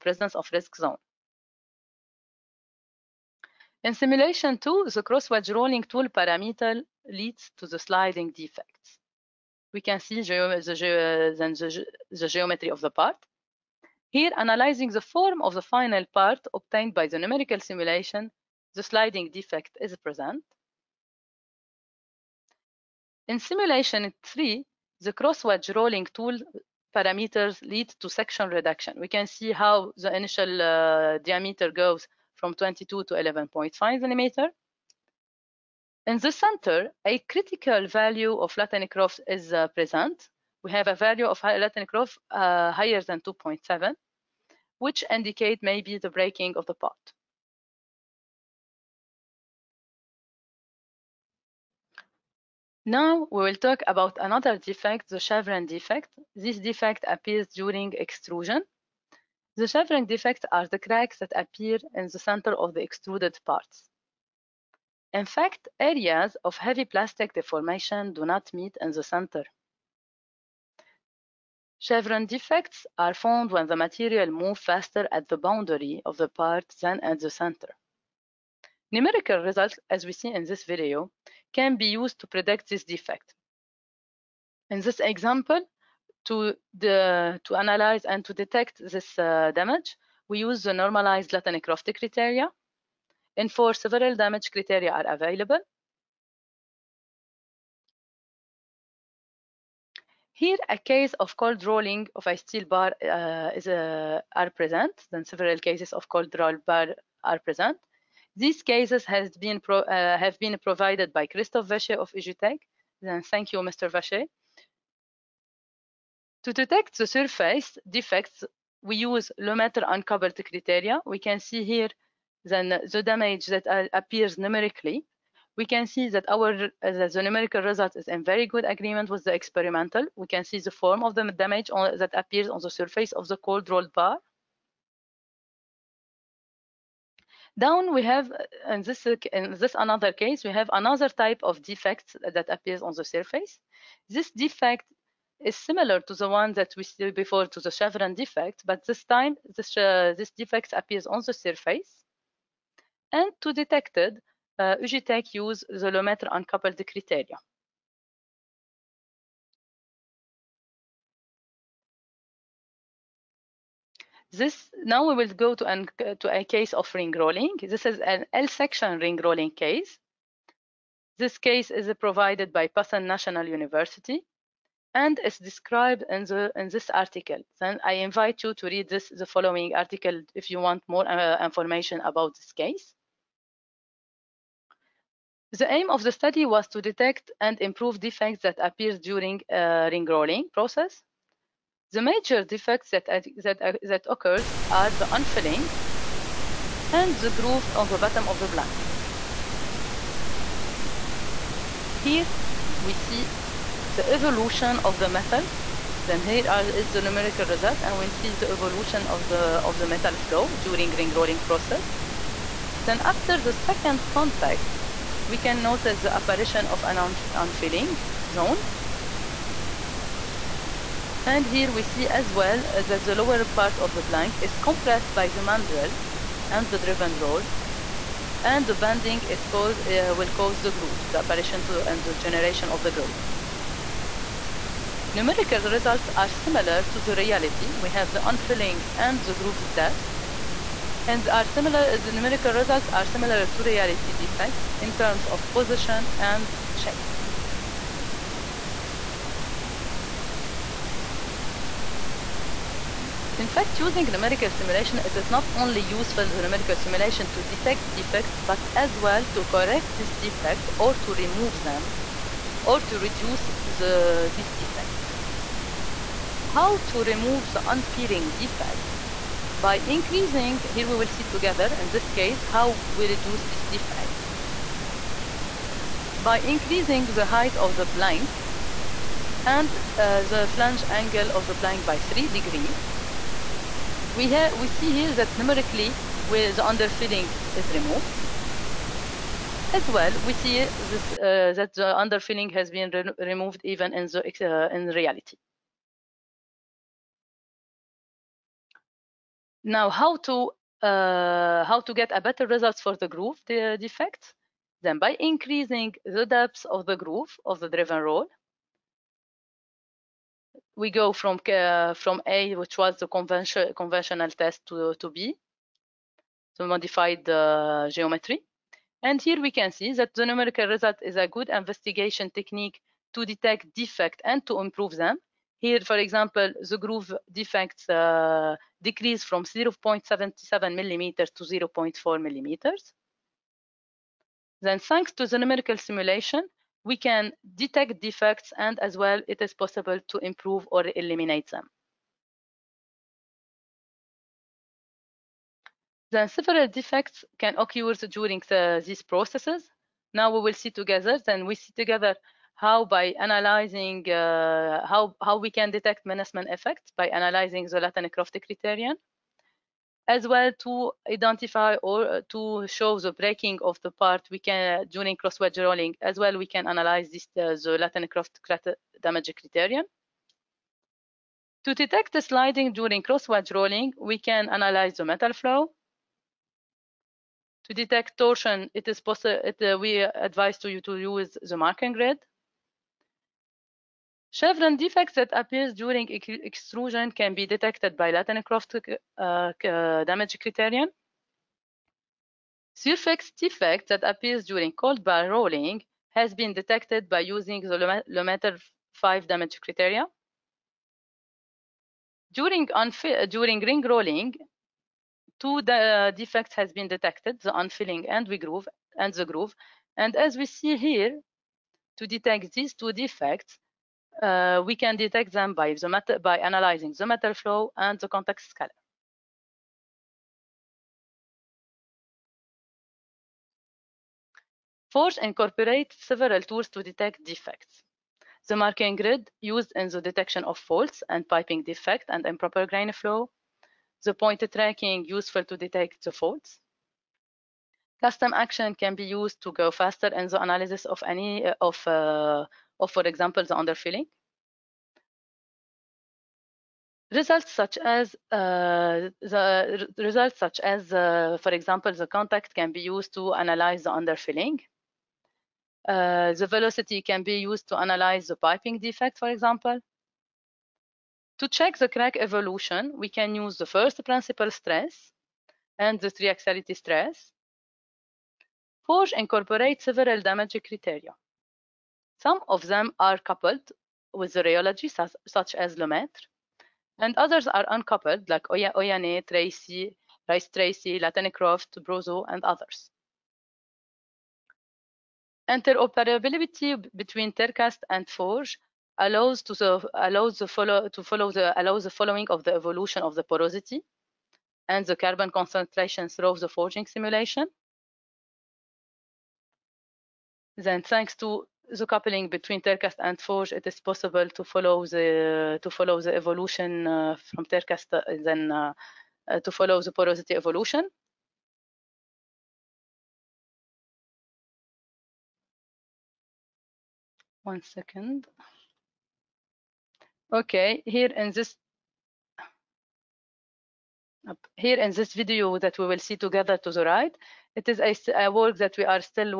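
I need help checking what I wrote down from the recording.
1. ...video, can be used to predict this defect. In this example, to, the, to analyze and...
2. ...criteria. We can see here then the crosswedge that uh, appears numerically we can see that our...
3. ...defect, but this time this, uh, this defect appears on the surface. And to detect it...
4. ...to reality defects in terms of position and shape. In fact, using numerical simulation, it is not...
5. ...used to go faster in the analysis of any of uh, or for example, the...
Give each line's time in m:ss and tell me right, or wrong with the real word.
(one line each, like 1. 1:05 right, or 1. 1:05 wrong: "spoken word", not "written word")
1. 1:20 right
2. 2:00 wrong: "damage", not "crosswedge"
3. 2:28 right
4. 4:03 right
5. 7:19 right.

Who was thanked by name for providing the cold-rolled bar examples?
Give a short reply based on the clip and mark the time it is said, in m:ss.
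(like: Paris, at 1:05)
Christophe Vacher, at 1:51.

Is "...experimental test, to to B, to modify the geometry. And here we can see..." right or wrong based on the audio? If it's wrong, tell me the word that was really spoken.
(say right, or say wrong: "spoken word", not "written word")
wrong: "conventional", not "experimental".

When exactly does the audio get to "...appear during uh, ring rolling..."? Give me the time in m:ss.
3:08.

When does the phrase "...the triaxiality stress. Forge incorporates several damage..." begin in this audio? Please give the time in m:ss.
7:45.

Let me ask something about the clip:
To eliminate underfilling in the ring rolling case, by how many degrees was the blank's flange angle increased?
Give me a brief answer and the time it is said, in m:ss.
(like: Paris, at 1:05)
3 degrees, at 4:41.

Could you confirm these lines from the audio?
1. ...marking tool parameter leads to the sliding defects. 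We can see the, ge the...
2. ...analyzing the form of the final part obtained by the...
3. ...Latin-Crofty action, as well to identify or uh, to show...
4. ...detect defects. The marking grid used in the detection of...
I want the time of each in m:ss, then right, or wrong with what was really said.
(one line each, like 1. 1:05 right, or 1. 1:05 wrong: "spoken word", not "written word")
1. 0:05 wrong: "rolling", not "marking"
2. 0:14 right
3. 5:57 wrong: "criterion", not "action"
4. 7:06 right.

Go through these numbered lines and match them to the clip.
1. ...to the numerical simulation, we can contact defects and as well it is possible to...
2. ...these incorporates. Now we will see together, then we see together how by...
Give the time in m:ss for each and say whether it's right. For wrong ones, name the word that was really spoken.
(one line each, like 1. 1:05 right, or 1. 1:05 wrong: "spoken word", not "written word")
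1. 5:35 wrong: "detect", not "contact"
2. 5:48 wrong: "processes", not "incorporates".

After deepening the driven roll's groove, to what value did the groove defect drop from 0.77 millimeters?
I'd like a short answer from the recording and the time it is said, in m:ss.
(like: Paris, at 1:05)
0.4 millimeters, at 5:31.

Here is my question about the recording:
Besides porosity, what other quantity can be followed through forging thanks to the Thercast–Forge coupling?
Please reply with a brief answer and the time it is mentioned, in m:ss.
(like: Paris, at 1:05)
Carbon concentration, at 8:14.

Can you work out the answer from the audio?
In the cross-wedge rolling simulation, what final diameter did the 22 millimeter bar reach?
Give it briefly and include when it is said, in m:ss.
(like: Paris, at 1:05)
11.5 millimeters, at 0:33.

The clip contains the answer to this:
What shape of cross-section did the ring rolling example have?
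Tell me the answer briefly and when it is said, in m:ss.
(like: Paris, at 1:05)
L-section, at 2:48.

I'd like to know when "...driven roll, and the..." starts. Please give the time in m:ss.
3:46.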